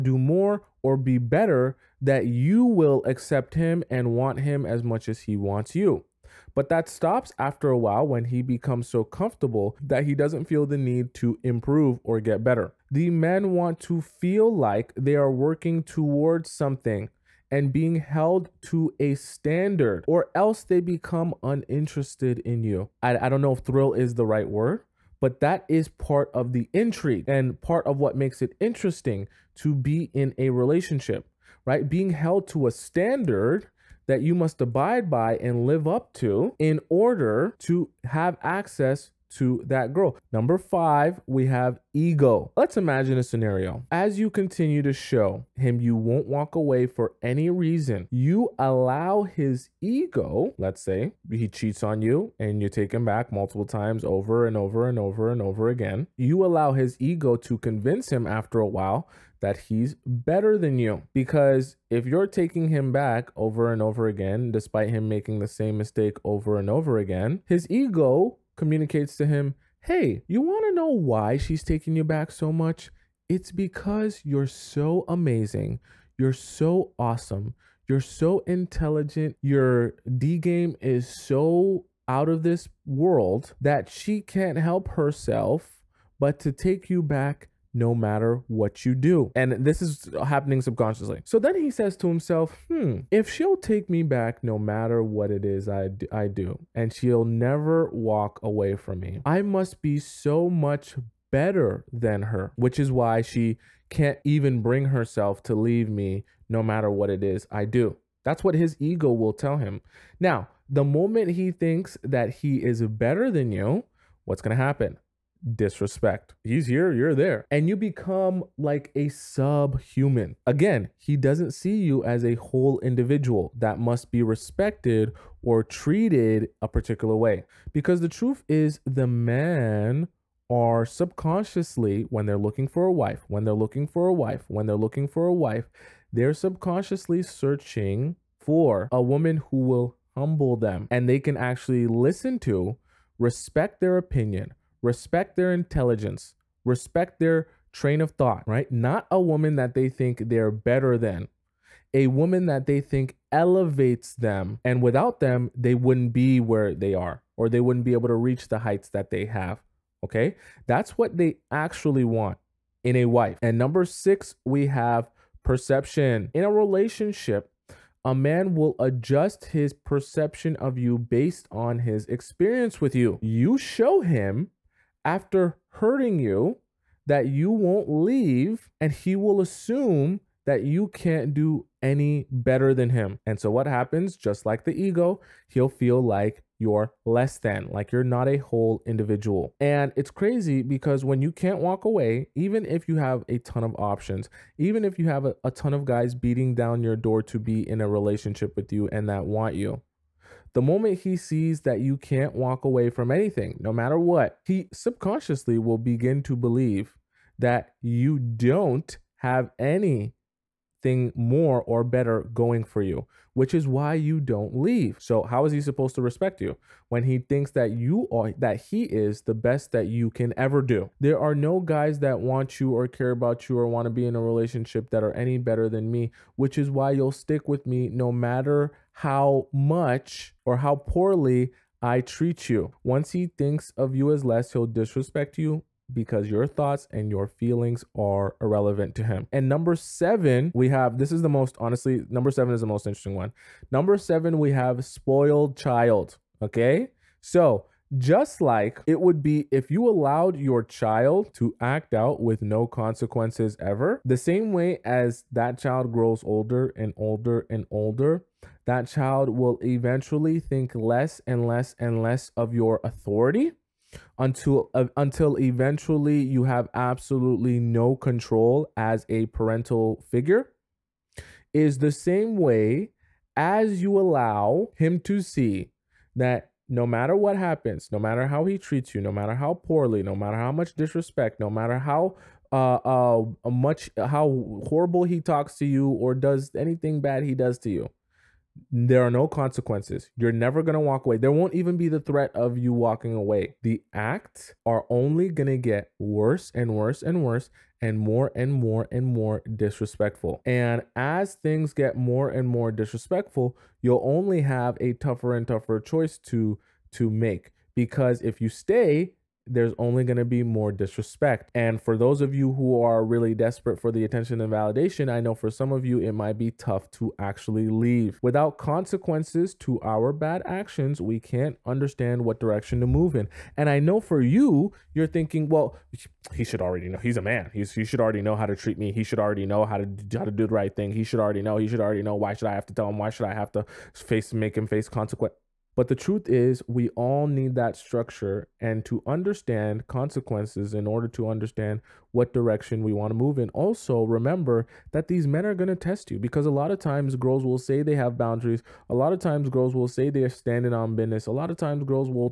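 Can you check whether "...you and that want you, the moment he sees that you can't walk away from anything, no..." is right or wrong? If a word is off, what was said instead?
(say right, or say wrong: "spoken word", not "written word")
right.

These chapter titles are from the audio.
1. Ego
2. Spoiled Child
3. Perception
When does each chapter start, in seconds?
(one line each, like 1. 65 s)
1. 39 s
2. 238 s
3. 163 s.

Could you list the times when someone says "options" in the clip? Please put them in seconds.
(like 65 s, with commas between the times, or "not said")
193 s.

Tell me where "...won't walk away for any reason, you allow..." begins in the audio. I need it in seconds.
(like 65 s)
45 s.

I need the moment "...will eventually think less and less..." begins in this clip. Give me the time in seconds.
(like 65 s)
259 s.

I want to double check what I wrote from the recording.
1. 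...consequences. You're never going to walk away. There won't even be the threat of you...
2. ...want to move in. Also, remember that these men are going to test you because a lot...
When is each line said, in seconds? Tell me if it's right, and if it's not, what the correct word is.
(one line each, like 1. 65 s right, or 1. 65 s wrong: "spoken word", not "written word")
1. 289 s right
2. 342 s right.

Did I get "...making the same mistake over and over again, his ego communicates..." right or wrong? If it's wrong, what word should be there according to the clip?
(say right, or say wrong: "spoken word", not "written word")
right.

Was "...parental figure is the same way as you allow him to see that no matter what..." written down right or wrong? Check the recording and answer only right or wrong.
right.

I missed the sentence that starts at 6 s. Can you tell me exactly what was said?
But that stops after a while when he becomes so comfortable that he doesn't feel the need to improve or get better.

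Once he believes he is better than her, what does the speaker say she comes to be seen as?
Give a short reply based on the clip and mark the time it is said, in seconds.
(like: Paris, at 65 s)
Subhuman, at 119 s.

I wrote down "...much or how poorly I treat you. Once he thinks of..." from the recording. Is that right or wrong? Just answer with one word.
right.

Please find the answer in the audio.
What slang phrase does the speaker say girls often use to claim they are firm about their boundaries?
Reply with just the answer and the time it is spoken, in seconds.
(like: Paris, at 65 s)
Standing on business, at 350 s.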